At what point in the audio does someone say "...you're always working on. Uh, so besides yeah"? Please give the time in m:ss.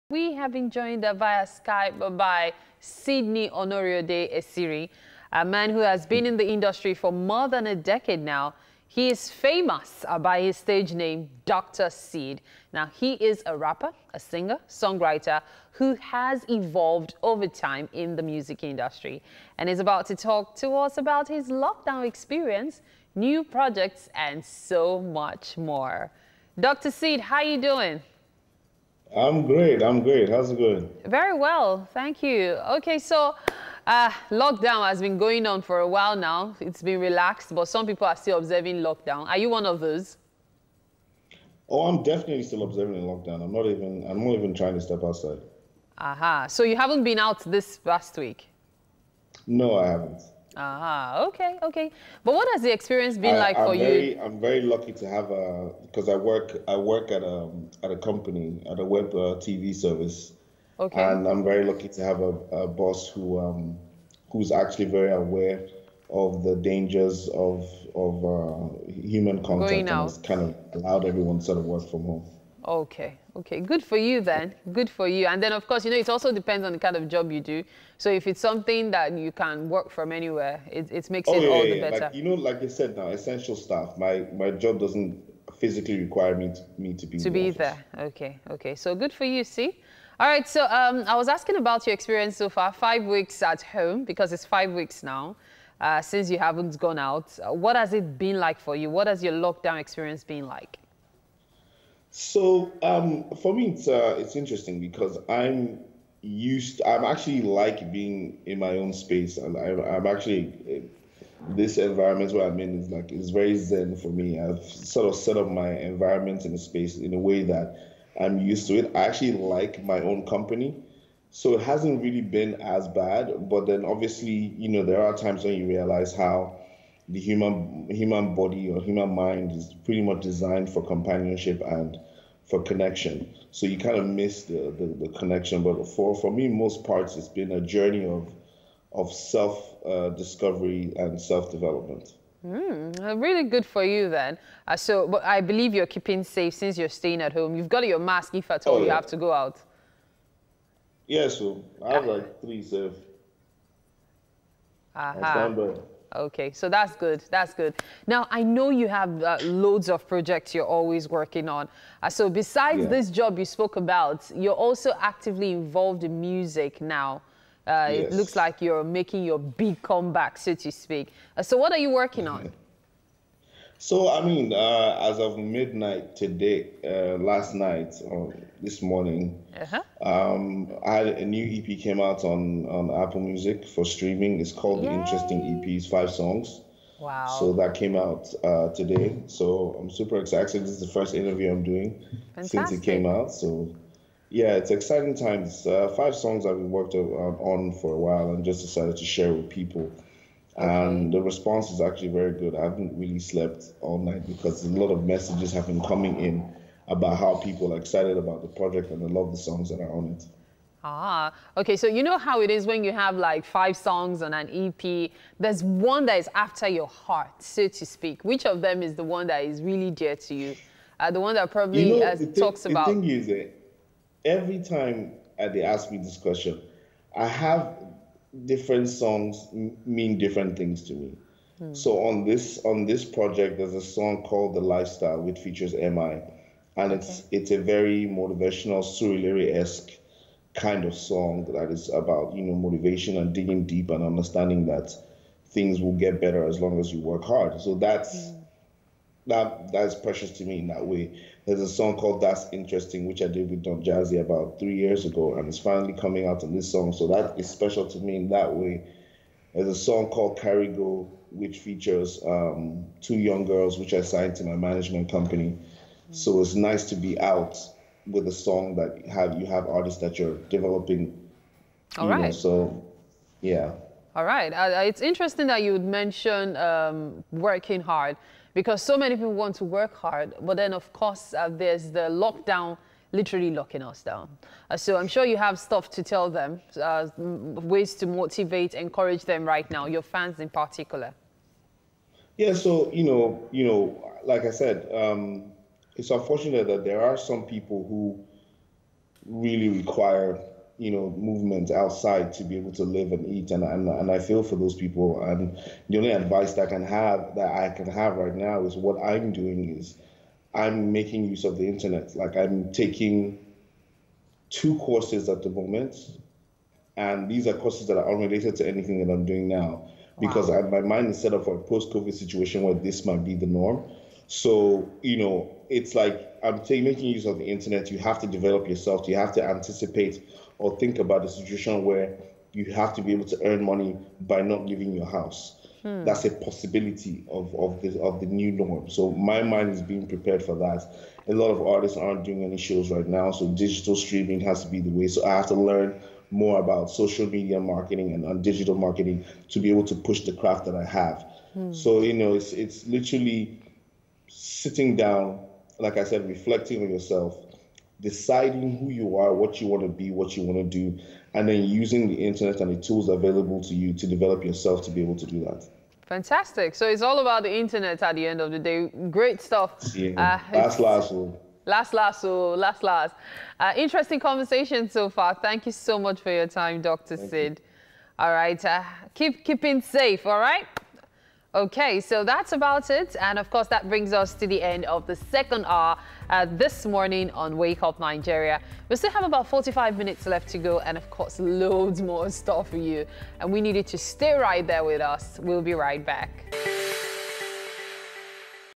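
2:40.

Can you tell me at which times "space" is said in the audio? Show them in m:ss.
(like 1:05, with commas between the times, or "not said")
1:48, 1:56.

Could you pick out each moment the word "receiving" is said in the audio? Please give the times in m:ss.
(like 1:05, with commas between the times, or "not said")
not said.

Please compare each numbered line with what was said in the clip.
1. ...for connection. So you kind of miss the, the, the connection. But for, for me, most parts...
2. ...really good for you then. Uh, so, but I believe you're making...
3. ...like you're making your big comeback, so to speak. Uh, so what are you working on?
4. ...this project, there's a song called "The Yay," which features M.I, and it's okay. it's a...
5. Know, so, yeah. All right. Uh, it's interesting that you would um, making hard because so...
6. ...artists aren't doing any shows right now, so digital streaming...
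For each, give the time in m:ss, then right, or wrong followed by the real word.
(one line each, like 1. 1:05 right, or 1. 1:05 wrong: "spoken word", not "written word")
1. 2:12 right
2. 2:23 wrong: "keeping", not "making"
3. 2:48 right
4. 3:52 wrong: "Lifestyle", not "Yay"
5. 4:32 wrong: "working", not "making"
6. 5:41 right.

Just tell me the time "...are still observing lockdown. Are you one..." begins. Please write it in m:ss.
0:38.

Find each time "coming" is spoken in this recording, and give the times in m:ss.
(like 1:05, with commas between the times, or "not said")
3:25, 4:15.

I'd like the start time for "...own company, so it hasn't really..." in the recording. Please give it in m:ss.
2:00.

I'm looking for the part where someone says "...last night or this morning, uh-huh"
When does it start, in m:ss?
2:57.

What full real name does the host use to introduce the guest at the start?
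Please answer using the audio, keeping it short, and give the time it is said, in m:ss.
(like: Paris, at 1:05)
Sidney Onoriode Esiri, at 0:02.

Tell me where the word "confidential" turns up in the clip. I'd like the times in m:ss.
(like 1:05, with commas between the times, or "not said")
not said.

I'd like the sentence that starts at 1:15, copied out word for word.
And then, of course, you know, it also depends on the kind of job you do.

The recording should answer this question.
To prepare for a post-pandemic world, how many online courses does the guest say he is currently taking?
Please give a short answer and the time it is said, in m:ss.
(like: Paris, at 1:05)
2, at 5:14.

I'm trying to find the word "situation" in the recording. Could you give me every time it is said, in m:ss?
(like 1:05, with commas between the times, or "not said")
5:22, 5:31.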